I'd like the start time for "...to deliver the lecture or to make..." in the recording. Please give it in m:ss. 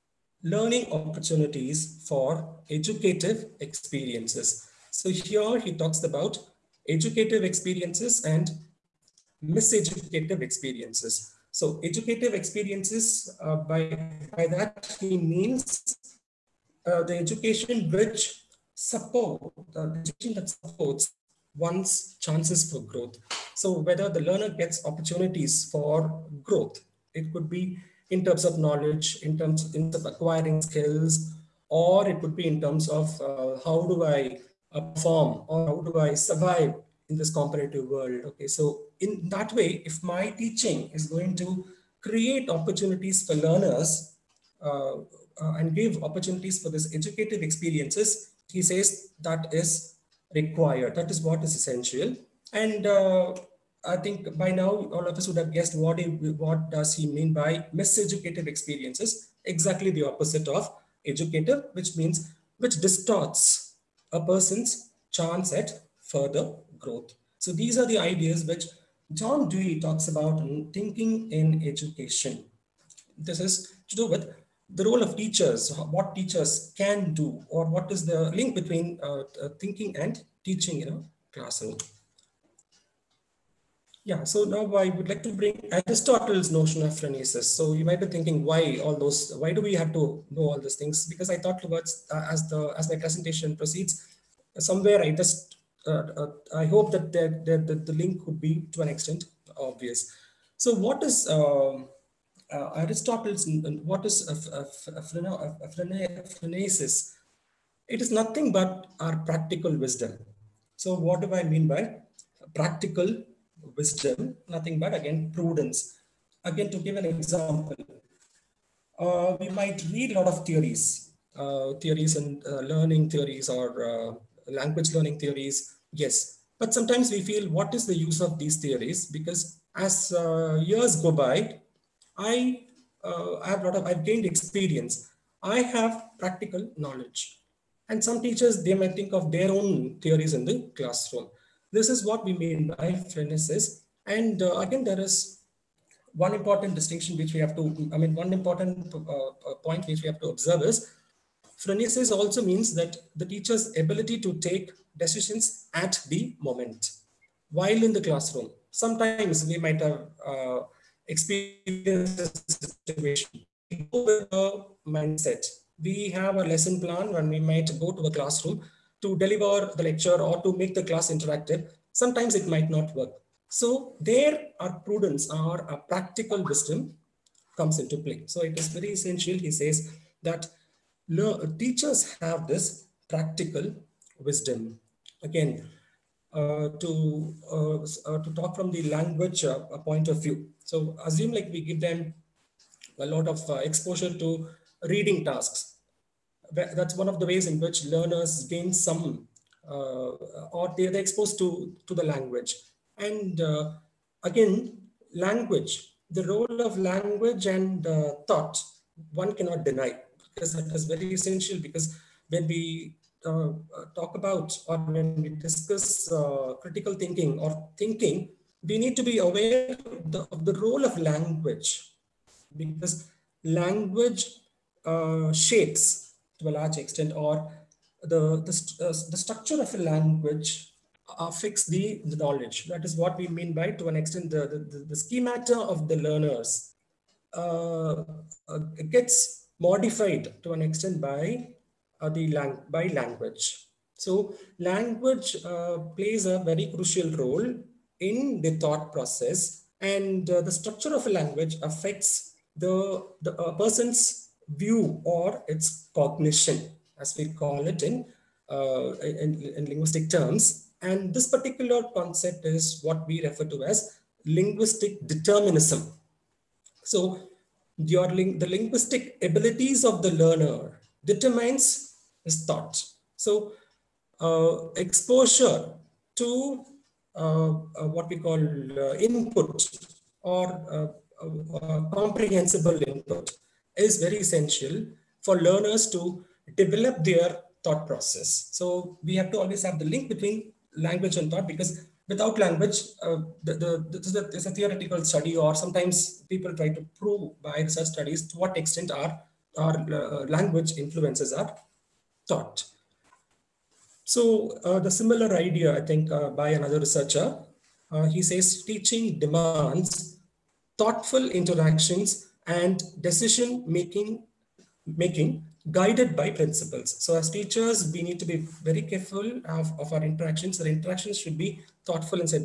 2:49.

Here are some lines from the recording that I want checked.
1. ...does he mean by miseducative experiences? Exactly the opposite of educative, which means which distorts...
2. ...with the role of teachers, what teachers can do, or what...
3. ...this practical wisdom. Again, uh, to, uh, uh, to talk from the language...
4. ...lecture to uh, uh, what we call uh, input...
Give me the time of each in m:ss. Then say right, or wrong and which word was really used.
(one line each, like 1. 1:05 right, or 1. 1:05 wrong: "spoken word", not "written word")
1. 0:56 right
2. 1:14 right
3. 3:02 right
4. 4:34 wrong: "exposure", not "lecture".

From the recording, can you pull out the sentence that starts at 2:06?
But sometimes we feel, what is the use of these theories?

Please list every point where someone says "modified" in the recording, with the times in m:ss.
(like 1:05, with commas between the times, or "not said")
3:59.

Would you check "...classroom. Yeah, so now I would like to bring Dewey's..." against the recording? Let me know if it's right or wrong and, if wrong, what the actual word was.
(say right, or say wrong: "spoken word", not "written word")
wrong: "Aristotle", not "Dewey".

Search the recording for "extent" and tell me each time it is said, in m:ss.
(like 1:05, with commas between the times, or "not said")
1:38, 3:46, 3:53, 4:00, 4:58.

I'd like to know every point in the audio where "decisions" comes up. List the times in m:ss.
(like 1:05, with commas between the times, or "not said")
2:34, 5:13.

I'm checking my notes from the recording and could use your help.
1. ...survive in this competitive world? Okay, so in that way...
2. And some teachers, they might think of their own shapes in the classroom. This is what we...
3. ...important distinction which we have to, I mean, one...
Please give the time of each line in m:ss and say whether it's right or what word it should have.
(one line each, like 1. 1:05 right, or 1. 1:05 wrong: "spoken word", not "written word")
1. 0:36 right
2. 2:17 wrong: "theories", not "shapes"
3. 2:26 right.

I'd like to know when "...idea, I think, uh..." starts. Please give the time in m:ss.
5:05.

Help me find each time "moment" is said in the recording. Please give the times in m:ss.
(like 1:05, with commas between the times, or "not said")
2:36.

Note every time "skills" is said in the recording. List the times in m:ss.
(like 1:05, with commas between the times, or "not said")
0:30.